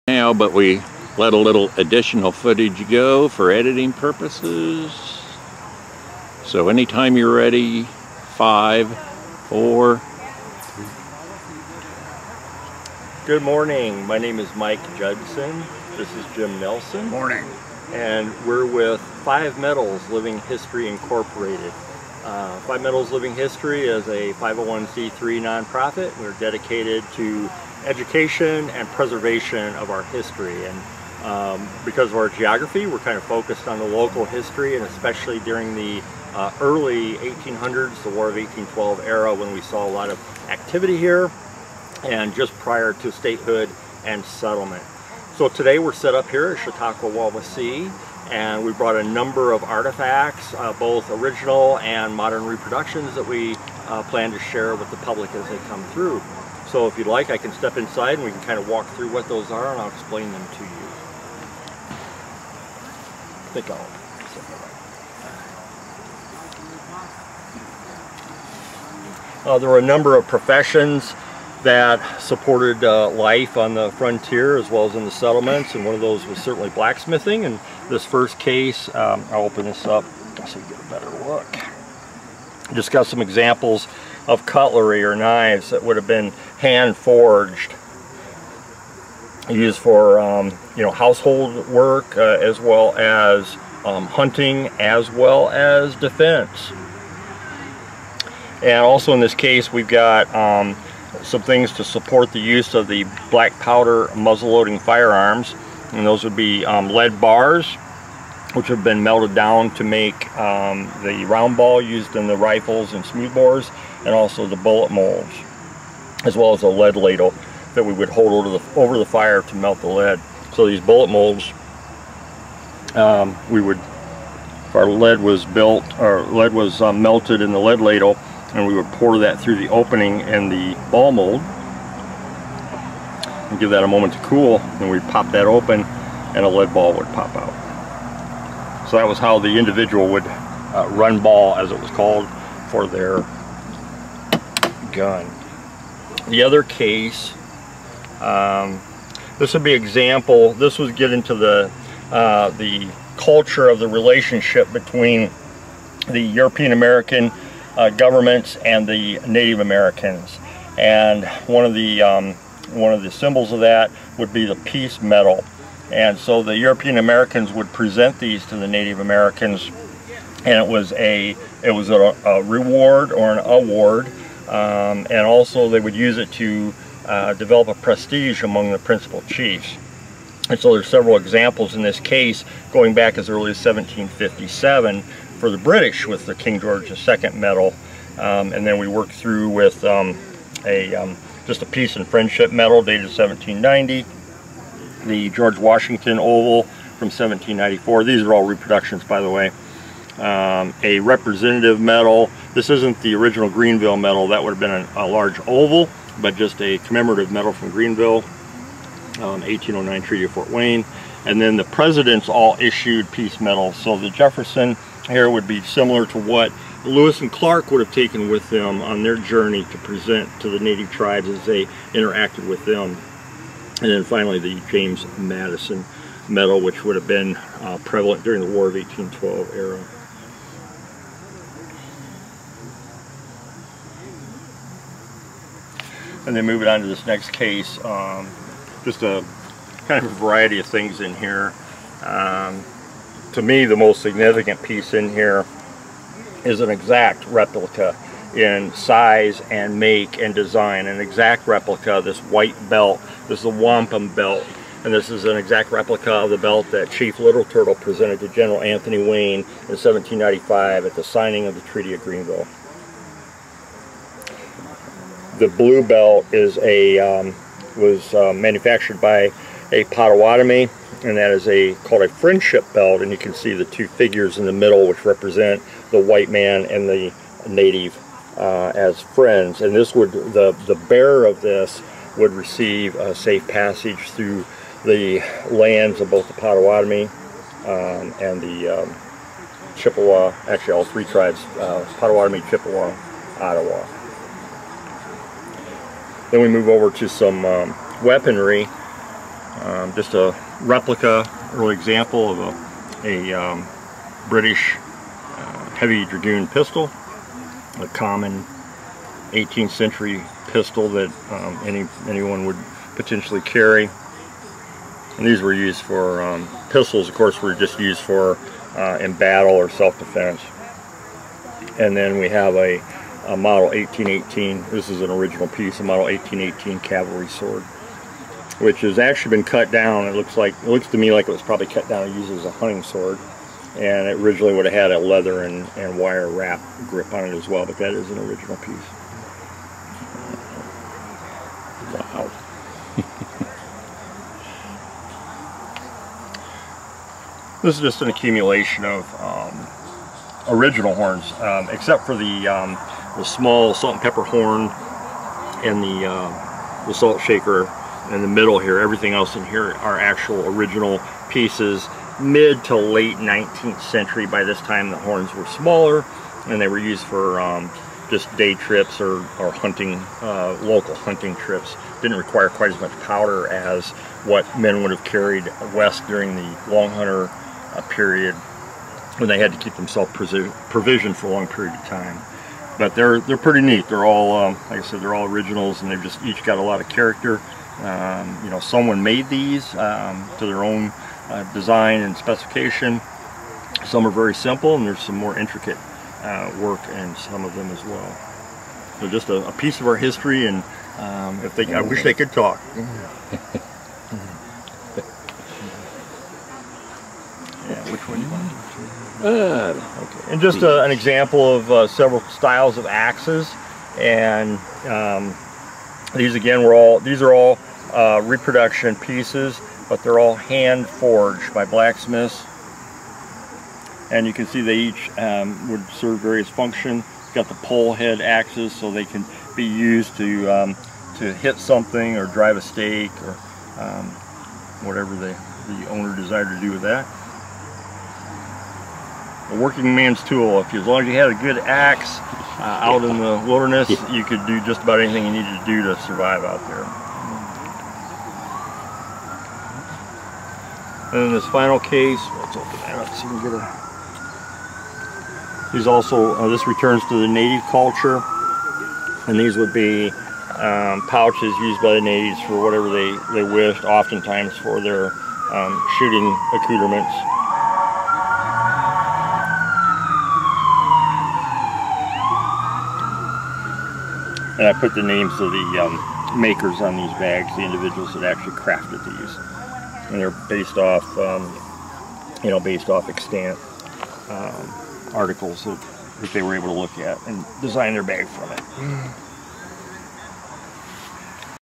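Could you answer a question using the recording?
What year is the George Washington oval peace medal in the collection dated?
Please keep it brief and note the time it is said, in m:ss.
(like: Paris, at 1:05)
1794, at 3:17.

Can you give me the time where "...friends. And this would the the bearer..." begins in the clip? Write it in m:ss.
4:39.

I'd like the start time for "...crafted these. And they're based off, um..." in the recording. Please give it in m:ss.
7:58.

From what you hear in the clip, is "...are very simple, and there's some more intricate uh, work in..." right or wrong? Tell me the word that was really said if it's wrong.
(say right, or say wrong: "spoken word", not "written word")
right.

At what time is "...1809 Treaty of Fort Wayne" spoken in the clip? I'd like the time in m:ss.
3:29.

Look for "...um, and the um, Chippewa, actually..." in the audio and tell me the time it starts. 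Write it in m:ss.
4:47.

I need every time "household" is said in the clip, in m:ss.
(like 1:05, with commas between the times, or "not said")
1:30.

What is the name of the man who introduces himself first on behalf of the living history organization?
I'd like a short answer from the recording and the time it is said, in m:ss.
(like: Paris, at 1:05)
Mike Judson, at 0:14.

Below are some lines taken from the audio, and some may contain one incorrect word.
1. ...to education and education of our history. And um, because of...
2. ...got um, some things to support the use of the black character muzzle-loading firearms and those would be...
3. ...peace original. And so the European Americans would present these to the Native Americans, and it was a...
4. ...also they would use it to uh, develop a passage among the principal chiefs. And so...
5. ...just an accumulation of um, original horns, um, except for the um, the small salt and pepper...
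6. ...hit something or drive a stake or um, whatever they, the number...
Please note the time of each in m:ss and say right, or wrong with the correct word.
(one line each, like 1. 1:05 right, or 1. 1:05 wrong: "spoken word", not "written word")
1. 0:27 wrong: "preservation", not "education"
2. 1:39 wrong: "powder", not "character"
3. 2:44 wrong: "medal", not "original"
4. 2:55 wrong: "prestige", not "passage"
5. 5:47 right
6. 7:11 wrong: "owner", not "number".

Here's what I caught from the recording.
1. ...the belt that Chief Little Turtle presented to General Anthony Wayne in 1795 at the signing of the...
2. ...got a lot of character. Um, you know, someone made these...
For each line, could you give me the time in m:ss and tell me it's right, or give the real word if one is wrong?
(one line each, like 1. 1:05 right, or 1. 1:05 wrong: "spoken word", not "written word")
1. 4:16 right
2. 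6:26 right.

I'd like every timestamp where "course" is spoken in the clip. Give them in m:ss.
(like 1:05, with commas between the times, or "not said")
5:17.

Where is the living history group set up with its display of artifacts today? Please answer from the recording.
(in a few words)
Chautauqua Wawasee.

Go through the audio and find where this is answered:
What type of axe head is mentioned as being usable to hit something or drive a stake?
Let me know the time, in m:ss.
7:07.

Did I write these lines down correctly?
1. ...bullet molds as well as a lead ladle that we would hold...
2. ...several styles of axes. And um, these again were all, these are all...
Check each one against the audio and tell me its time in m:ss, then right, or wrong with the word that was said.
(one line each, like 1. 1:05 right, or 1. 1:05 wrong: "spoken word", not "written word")
1. 1:54 right
2. 6:51 right.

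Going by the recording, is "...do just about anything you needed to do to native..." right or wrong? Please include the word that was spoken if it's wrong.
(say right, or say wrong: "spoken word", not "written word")
wrong: "survive", not "native".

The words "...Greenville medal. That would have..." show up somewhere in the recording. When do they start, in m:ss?
3:23.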